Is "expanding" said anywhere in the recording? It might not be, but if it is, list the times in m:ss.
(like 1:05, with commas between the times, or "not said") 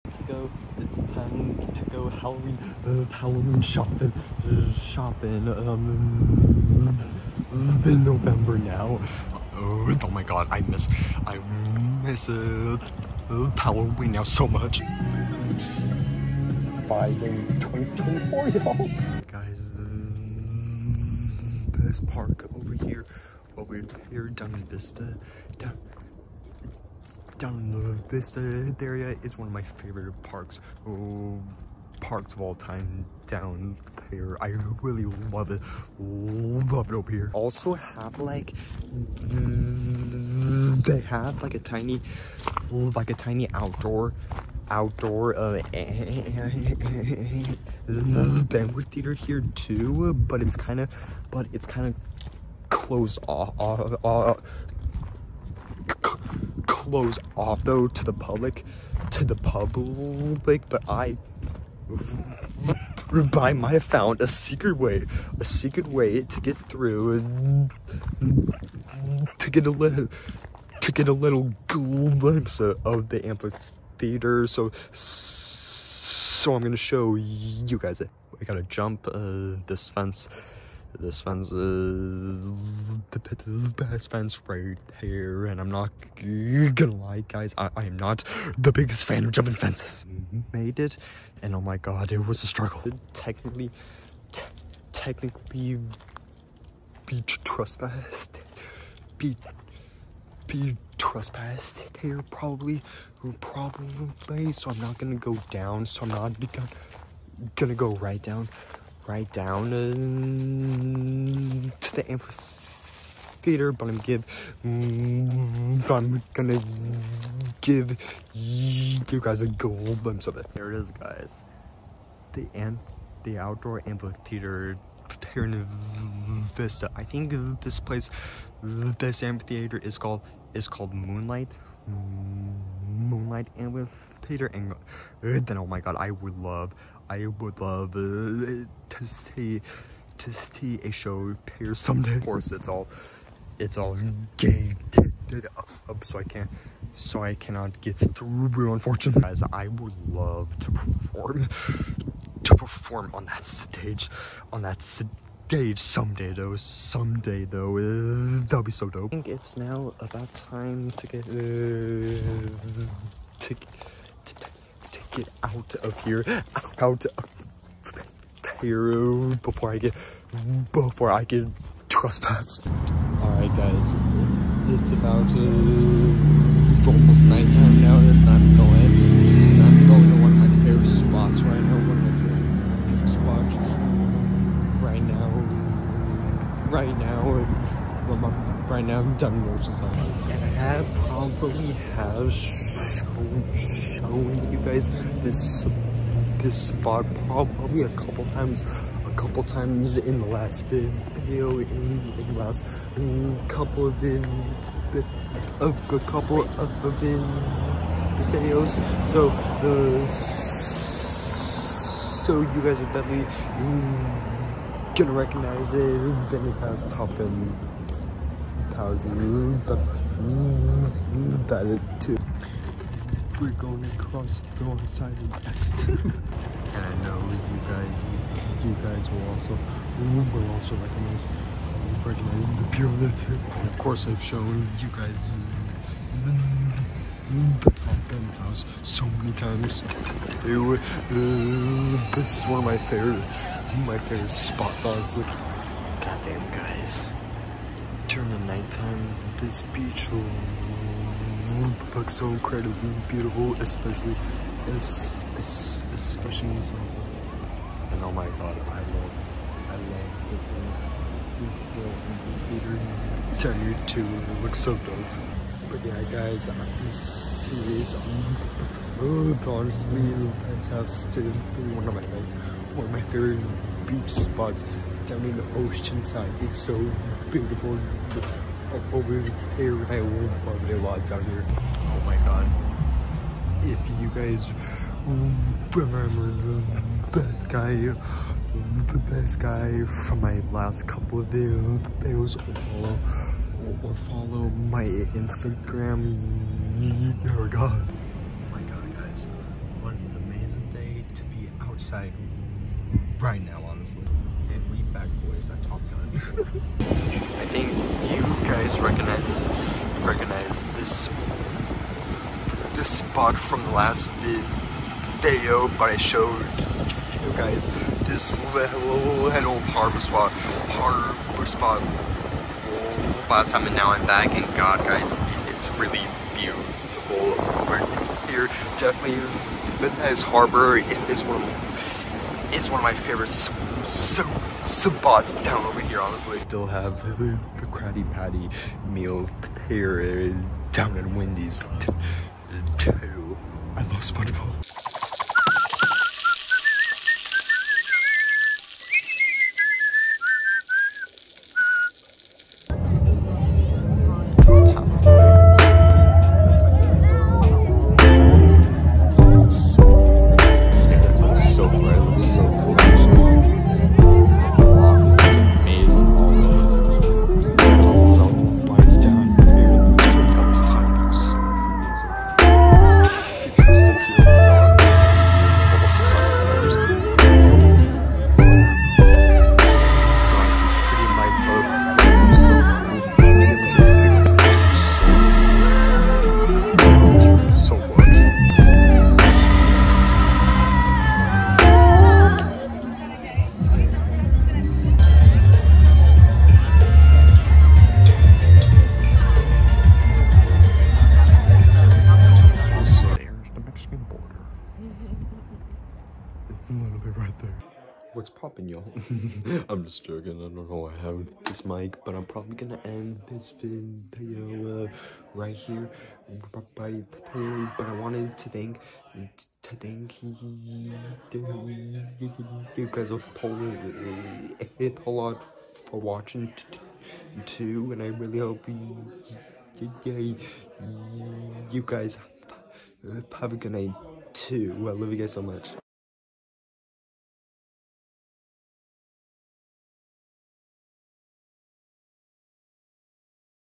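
not said.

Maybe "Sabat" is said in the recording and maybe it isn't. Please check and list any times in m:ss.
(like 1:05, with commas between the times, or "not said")
5:34.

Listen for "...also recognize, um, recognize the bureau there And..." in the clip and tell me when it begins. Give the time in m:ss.
3:50.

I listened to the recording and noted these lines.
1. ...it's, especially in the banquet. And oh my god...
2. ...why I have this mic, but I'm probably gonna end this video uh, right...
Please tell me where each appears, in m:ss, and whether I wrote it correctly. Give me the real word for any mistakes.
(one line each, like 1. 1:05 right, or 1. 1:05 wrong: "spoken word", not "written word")
1. 4:14 wrong: "sunset", not "banquet"
2. 6:50 right.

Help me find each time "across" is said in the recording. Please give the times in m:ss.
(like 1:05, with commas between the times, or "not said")
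3:43.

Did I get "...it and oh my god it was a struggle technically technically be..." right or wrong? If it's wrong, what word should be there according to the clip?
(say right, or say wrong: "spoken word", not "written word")
right.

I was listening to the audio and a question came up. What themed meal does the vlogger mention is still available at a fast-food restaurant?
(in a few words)
Krabby Patty meal.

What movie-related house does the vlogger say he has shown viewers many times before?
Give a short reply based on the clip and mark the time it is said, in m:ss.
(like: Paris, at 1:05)
Top Gun house, at 3:57.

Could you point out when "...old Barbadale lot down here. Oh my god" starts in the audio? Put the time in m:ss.
4:39.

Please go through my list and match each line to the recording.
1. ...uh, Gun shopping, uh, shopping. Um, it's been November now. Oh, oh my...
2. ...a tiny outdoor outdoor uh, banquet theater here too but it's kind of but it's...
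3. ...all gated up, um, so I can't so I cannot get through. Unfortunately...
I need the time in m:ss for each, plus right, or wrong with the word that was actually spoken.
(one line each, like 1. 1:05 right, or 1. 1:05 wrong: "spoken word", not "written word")
1. 0:02 wrong: "Halloween", not "Gun"
2. 0:43 right
3. 2:23 right.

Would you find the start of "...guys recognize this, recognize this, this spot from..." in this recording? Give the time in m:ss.
5:08.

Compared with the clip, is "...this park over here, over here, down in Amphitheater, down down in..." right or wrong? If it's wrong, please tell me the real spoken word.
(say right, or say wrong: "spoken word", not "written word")
wrong: "Vista", not "Amphitheater".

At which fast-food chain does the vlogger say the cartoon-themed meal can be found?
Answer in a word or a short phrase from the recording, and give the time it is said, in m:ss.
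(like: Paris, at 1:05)
Wendy's, at 5:41.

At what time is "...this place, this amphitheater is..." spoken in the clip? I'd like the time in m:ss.
2:07.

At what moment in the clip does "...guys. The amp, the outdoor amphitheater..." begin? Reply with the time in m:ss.
2:00.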